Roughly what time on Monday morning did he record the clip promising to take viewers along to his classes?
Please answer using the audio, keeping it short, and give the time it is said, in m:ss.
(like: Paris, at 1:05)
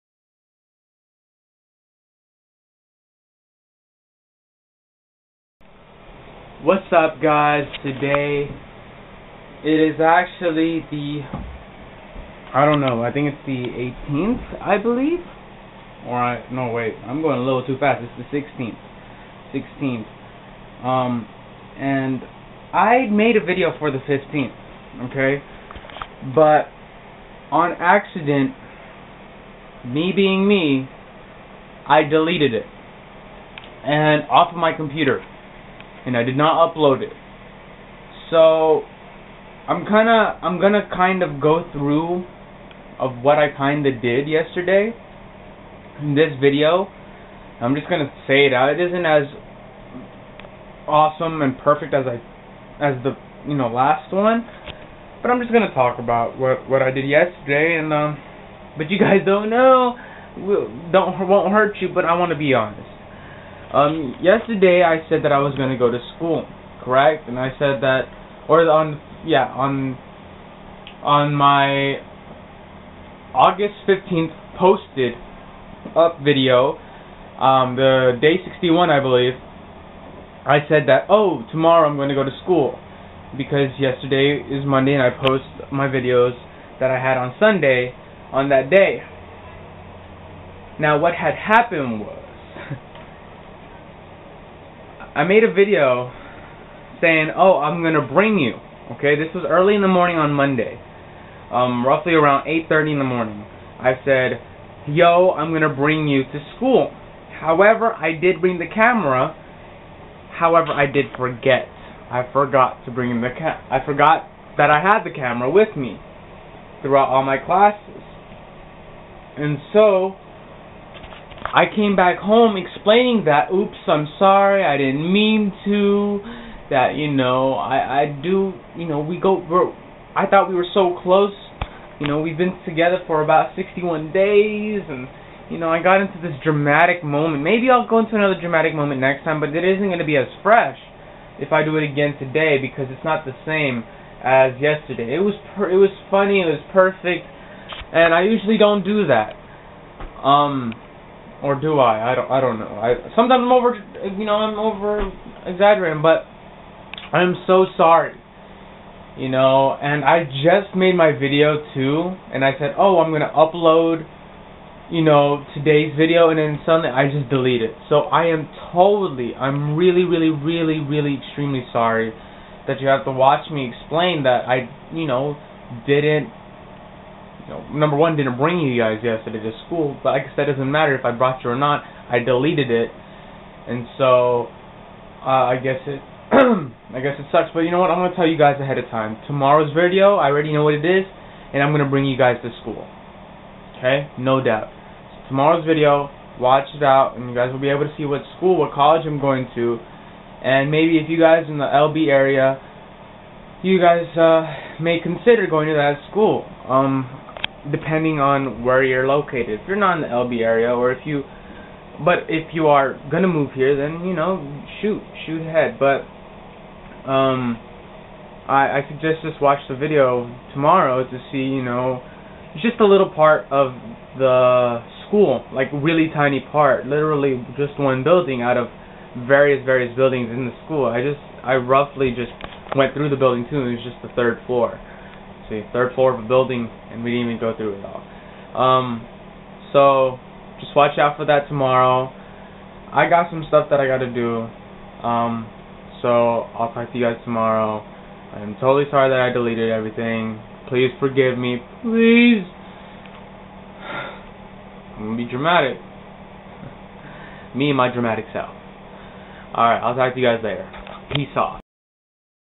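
8:30, at 1:42.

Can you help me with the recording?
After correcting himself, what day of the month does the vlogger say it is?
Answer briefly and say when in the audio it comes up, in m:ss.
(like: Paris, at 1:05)
16th, at 0:18.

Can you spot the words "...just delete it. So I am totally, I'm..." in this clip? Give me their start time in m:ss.
2:47.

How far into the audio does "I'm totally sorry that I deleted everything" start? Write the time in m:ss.
4:08.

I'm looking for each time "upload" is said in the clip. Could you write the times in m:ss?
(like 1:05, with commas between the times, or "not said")
0:36, 2:43.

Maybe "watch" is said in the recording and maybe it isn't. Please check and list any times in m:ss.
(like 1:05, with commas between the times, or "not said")
2:53, 3:16, 3:39, 4:00.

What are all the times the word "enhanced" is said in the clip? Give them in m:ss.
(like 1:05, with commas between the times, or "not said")
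not said.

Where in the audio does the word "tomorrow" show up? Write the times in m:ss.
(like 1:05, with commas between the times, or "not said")
1:21, 3:09, 3:15, 3:40, 4:01, 4:07.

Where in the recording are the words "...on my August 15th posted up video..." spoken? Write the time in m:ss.
1:11.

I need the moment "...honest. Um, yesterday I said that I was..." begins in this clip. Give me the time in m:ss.
1:02.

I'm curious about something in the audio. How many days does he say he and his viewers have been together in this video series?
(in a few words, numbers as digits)
61.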